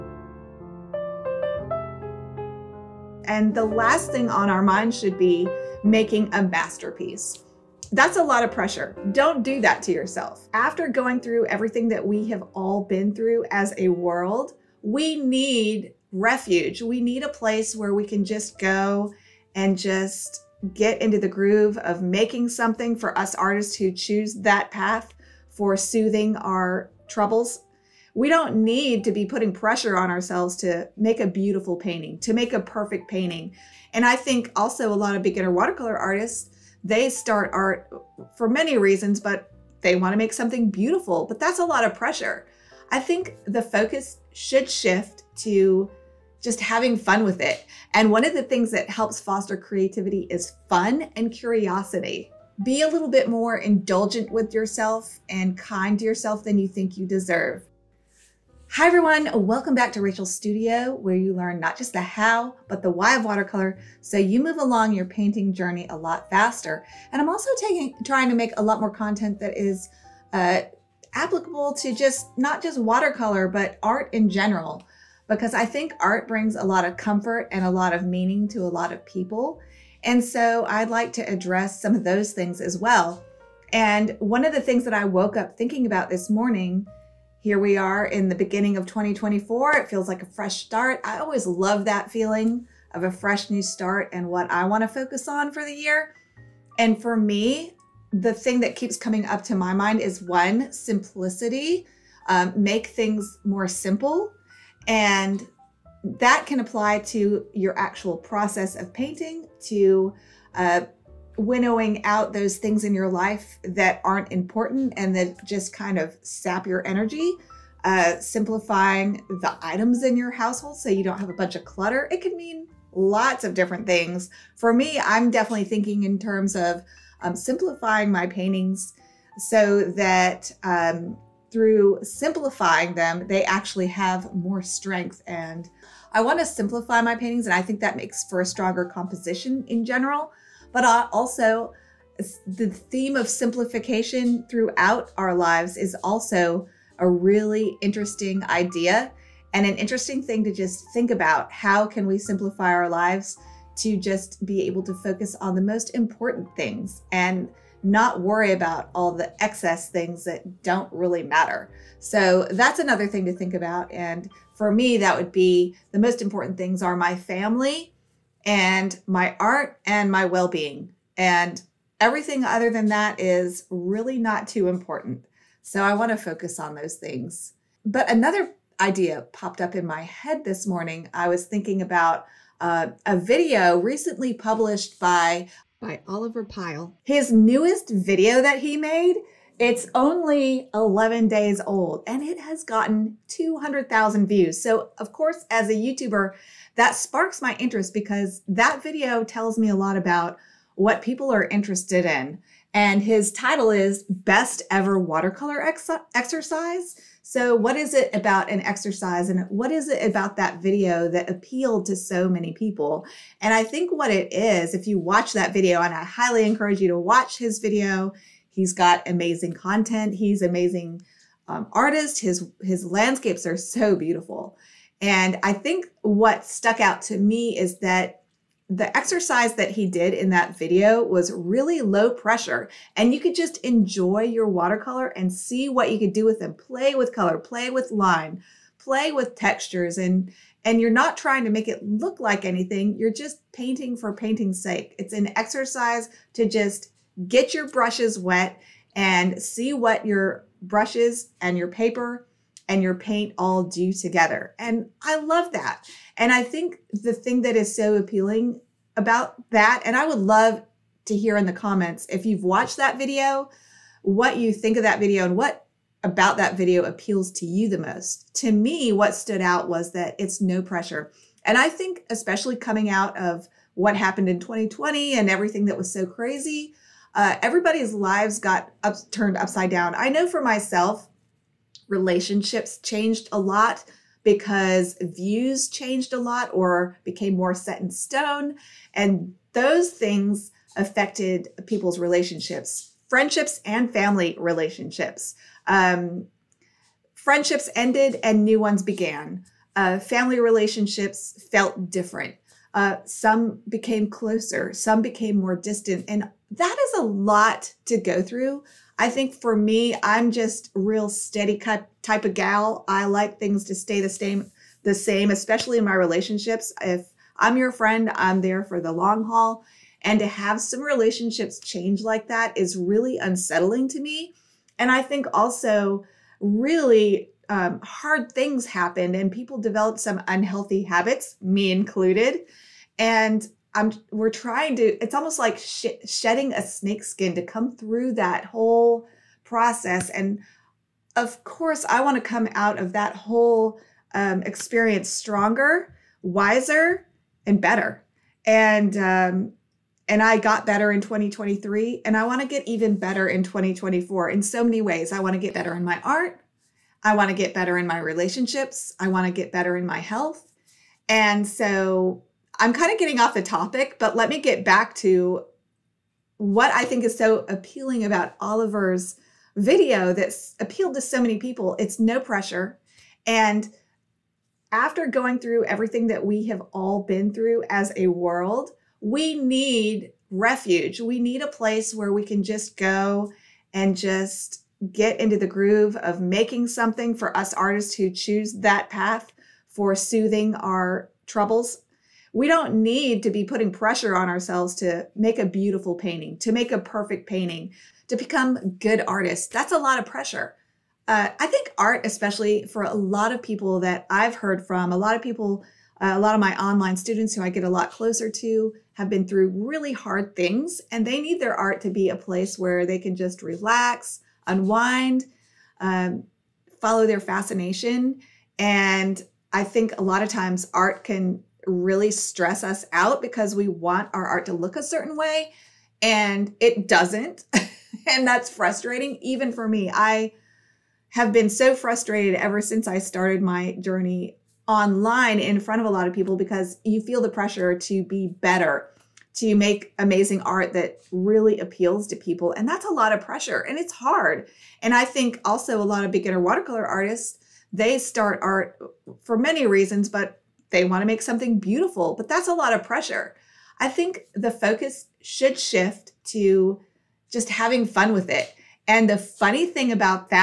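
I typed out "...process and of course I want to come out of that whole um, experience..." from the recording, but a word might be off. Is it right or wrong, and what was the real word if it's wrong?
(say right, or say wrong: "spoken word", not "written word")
right.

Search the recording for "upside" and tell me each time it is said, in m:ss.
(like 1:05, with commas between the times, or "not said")
4:39.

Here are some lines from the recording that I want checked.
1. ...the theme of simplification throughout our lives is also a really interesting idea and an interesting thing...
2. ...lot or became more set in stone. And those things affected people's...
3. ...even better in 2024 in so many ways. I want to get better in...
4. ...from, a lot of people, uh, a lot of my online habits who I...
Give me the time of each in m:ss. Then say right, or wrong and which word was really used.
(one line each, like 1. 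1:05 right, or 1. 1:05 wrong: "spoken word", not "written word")
1. 2:22 right
2. 4:46 right
3. 5:52 right
4. 6:44 wrong: "students", not "habits".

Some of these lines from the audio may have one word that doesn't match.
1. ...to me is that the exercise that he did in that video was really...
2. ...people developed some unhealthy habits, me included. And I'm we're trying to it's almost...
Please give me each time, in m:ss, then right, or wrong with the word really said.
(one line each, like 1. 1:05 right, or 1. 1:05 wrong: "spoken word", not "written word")
1. 3:47 right
2. 5:29 right.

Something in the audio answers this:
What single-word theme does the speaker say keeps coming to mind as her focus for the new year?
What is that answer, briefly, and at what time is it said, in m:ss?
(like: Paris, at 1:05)
Simplicity, at 1:40.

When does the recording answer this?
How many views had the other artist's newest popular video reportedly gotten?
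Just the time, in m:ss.
3:13.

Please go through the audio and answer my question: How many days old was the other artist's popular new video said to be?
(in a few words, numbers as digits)
11.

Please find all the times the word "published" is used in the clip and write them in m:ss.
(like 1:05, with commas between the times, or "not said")
3:04.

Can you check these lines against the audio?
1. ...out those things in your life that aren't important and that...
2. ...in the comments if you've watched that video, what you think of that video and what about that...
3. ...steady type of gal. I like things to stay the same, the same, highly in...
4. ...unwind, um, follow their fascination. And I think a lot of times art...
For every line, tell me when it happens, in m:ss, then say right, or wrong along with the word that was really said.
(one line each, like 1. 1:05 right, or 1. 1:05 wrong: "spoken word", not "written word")
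1. 1:52 right
2. 4:21 right
3. 5:11 wrong: "especially", not "highly"
4. 6:54 right.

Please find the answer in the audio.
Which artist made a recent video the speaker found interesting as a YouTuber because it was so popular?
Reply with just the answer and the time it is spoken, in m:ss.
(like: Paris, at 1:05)
Oliver Pyle, at 3:06.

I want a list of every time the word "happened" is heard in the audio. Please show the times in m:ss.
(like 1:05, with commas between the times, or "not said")
4:33, 5:28.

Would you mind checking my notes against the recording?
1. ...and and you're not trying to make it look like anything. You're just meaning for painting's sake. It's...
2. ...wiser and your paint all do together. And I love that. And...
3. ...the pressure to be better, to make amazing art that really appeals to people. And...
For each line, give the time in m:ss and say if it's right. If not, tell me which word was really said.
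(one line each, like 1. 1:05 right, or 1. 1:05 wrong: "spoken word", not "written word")
1. 3:59 wrong: "painting", not "meaning"
2. 4:11 wrong: "paper", not "wiser"
3. 7:17 right.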